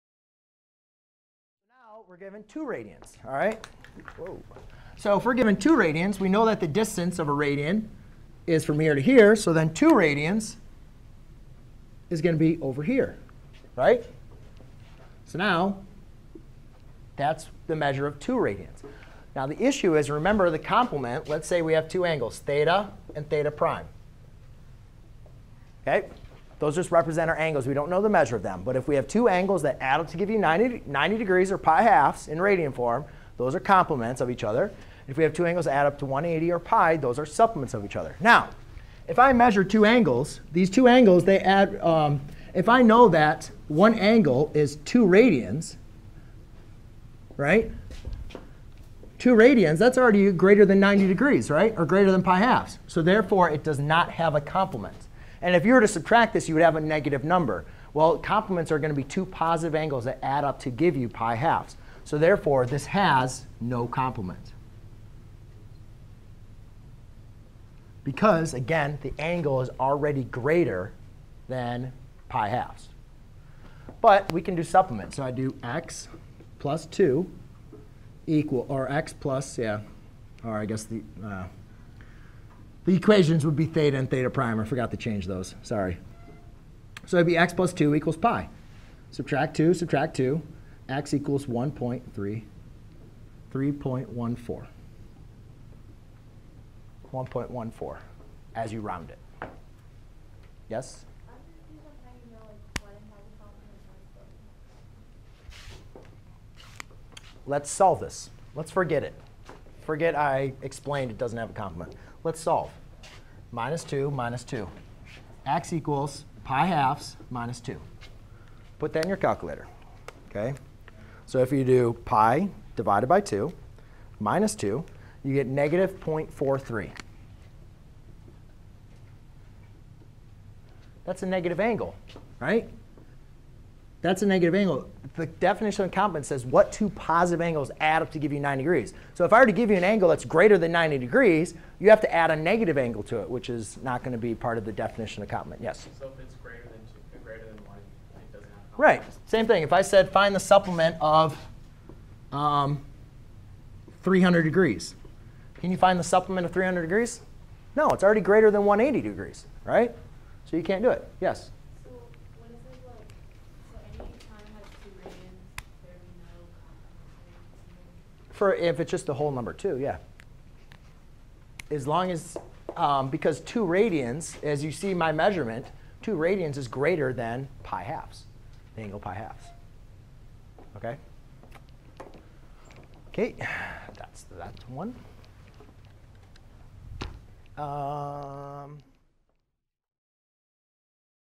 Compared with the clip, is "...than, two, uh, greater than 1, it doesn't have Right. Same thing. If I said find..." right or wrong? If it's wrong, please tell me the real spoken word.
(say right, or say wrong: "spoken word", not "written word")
right.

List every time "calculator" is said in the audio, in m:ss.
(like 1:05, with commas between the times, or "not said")
1:59.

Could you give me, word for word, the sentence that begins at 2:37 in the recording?
No, it's already greater than 180 degrees, right?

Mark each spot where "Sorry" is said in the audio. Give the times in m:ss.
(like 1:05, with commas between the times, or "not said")
1:25.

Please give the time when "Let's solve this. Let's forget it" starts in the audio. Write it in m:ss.
1:47.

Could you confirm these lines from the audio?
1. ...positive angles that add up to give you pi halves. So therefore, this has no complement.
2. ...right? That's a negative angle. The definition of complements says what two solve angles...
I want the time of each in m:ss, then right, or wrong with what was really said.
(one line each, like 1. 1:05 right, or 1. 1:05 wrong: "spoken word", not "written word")
1. 0:59 right
2. 2:12 wrong: "positive", not "solve".